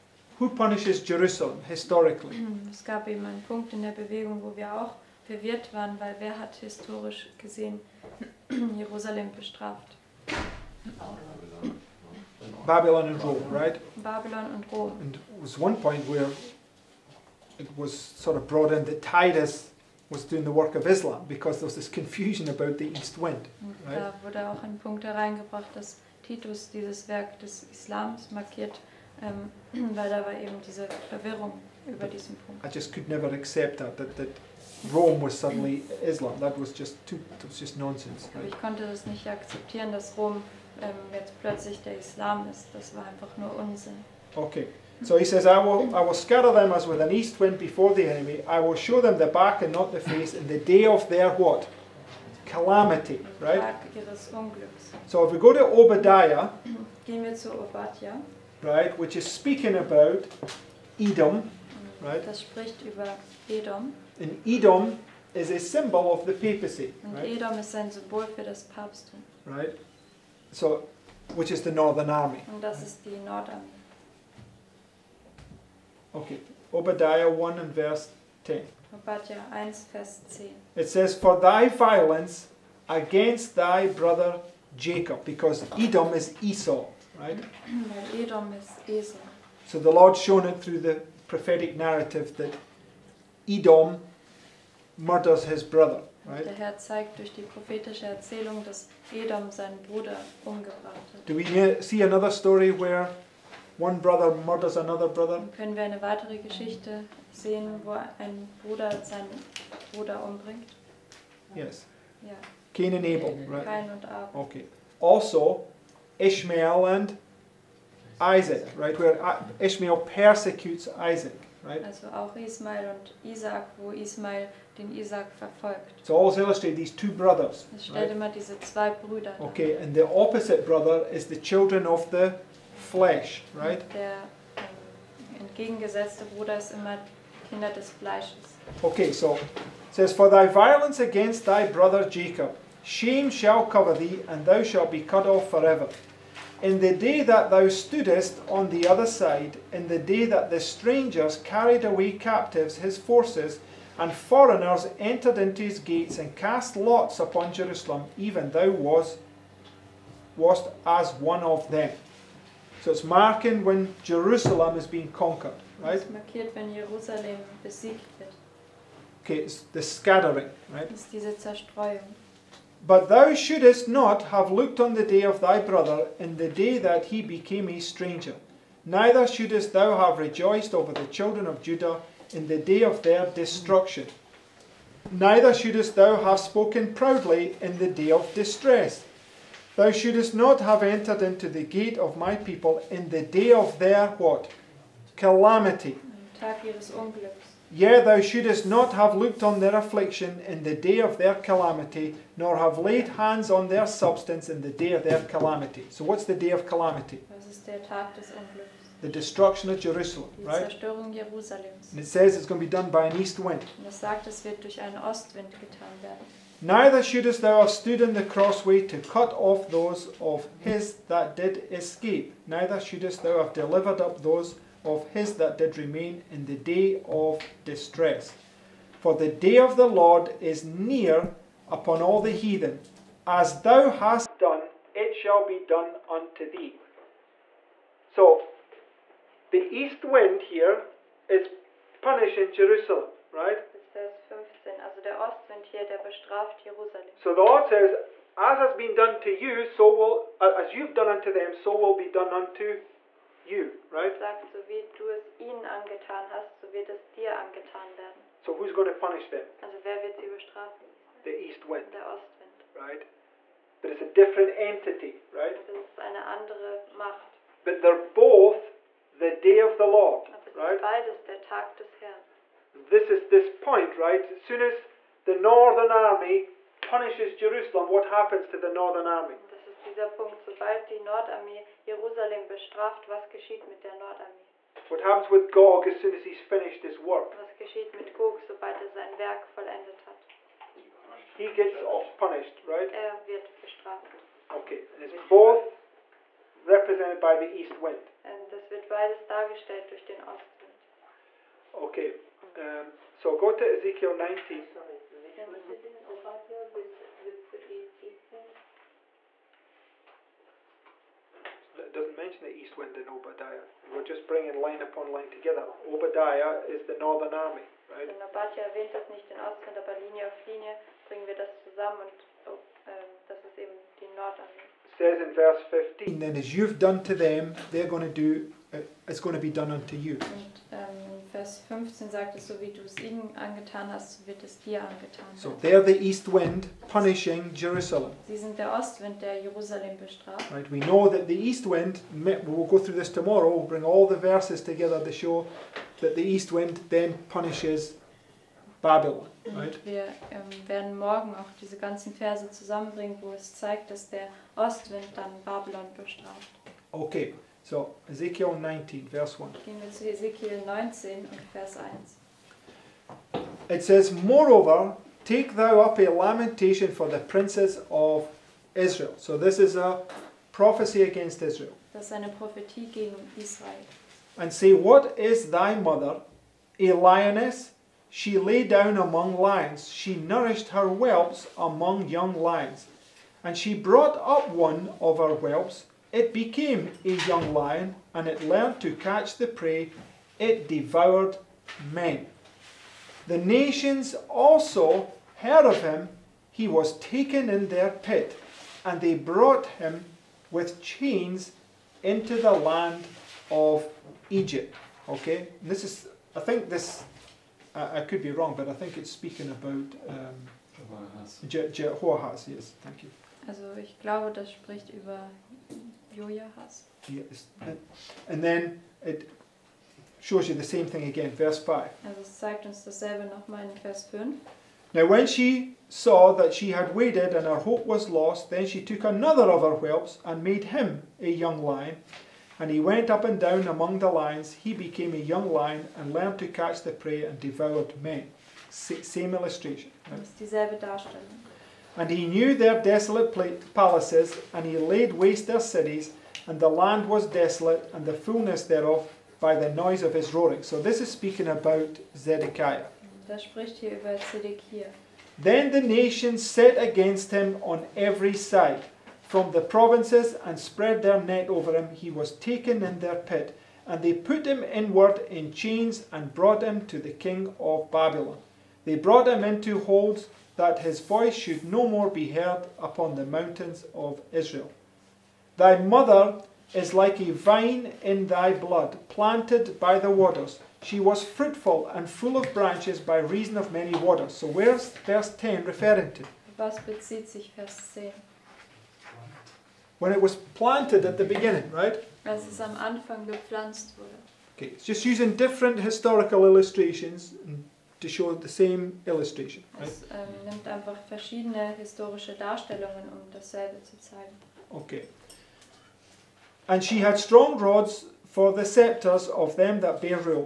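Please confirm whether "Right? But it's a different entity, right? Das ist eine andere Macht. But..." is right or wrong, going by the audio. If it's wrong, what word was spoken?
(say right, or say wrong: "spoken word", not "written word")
right.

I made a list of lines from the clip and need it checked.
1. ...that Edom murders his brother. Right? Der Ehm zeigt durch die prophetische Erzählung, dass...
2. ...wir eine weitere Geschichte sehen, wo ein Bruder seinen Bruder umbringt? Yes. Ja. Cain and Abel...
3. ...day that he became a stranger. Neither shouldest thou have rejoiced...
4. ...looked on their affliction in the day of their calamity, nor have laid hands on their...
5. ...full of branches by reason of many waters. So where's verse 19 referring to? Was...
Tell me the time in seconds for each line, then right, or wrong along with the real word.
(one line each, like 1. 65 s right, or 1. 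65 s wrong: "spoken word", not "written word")
1. 92 s wrong: "Herr", not "Ehm"
2. 105 s right
3. 176 s right
4. 199 s right
5. 482 s wrong: "10", not "19".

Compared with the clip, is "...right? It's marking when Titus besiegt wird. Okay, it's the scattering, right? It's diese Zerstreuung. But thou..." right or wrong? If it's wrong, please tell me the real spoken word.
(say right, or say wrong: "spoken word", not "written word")
wrong: "Jerusalem", not "Titus".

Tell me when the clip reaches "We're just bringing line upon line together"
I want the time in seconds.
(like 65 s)
313 s.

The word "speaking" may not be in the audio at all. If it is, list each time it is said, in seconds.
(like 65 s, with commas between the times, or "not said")
59 s, 409 s, 451 s.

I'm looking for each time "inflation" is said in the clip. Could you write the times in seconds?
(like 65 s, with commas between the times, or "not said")
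not said.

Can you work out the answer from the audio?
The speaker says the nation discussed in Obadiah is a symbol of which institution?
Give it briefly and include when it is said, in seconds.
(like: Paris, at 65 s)
The papacy, at 66 s.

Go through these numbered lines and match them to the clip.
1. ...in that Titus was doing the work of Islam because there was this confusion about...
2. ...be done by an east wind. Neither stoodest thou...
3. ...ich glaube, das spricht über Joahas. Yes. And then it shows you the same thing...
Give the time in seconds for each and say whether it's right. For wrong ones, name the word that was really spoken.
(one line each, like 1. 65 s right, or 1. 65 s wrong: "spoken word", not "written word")
1. 18 s right
2. 212 s wrong: "shouldest", not "stoodest"
3. 413 s right.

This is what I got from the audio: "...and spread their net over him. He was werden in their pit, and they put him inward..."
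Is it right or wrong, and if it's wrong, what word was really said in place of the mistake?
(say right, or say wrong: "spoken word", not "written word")
wrong: "taken", not "werden".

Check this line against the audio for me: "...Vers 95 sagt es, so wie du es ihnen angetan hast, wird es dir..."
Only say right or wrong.
wrong.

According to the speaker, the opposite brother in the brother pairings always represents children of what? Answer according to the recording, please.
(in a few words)
The flesh.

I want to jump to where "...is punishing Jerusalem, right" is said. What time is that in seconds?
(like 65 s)
241 s.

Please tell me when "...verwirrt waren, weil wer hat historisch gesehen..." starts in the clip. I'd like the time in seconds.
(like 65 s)
5 s.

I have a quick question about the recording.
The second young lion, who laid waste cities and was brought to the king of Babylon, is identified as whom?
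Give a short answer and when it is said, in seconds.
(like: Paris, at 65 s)
Zedekiah, at 452 s.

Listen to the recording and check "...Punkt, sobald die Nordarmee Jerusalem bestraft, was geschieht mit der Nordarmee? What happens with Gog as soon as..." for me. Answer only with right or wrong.
right.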